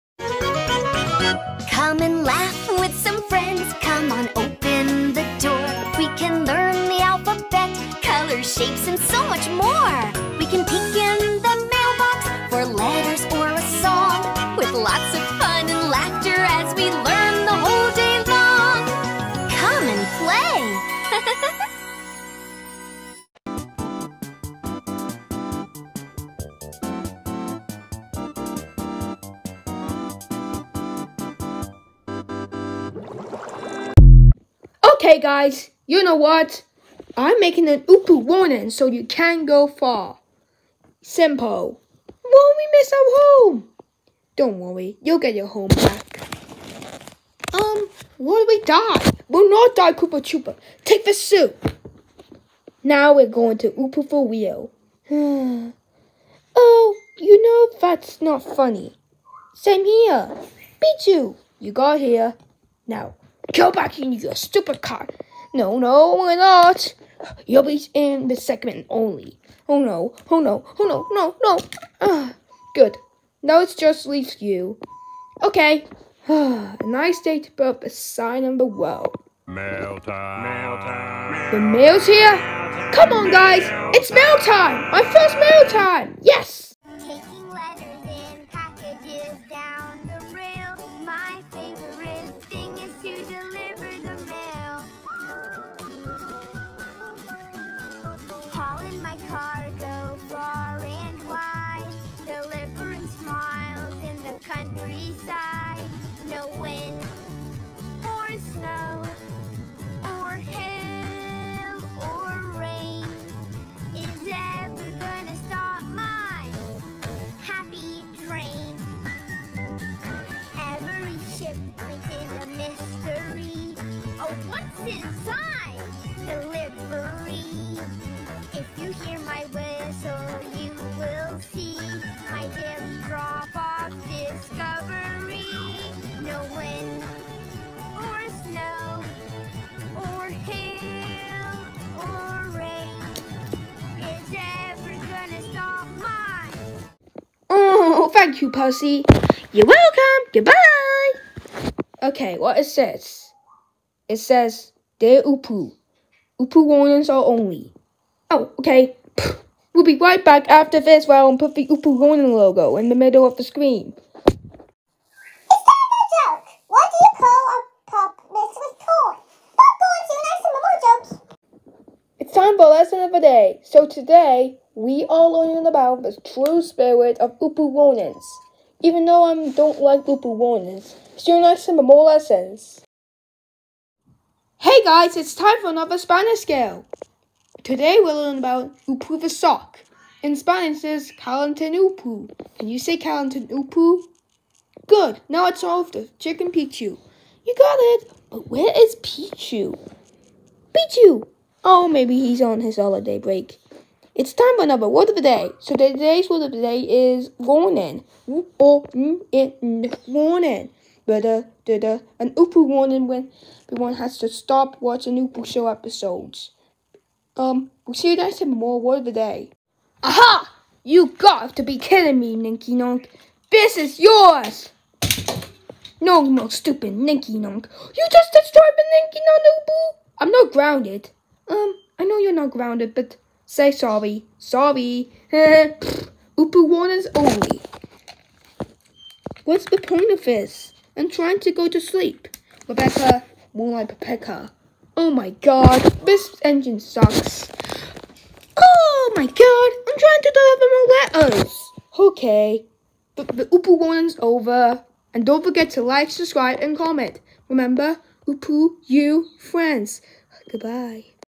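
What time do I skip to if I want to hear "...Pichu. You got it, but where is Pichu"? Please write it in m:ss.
3:16.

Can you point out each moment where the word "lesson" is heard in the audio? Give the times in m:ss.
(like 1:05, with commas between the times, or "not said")
2:52, 3:02.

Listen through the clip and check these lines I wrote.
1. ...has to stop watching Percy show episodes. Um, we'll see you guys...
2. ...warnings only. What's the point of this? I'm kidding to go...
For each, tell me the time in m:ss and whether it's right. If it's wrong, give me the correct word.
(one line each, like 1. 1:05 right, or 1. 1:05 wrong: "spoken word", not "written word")
1. 3:33 wrong: "Oopoo", not "Percy"
2. 3:56 wrong: "trying", not "kidding".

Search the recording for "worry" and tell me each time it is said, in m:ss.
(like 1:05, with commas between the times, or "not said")
0:44.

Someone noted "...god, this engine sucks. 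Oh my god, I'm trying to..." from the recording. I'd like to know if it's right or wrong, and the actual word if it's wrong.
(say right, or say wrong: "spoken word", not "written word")
right.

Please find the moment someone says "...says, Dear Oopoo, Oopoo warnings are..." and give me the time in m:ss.
2:34.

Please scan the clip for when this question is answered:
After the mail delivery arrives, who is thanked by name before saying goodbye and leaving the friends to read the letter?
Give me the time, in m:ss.
2:28.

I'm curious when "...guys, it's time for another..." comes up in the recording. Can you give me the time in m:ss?
3:04.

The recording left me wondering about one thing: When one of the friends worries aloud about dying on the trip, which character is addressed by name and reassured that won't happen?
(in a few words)
Koopa Troopa.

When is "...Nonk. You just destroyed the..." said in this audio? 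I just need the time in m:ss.
3:47.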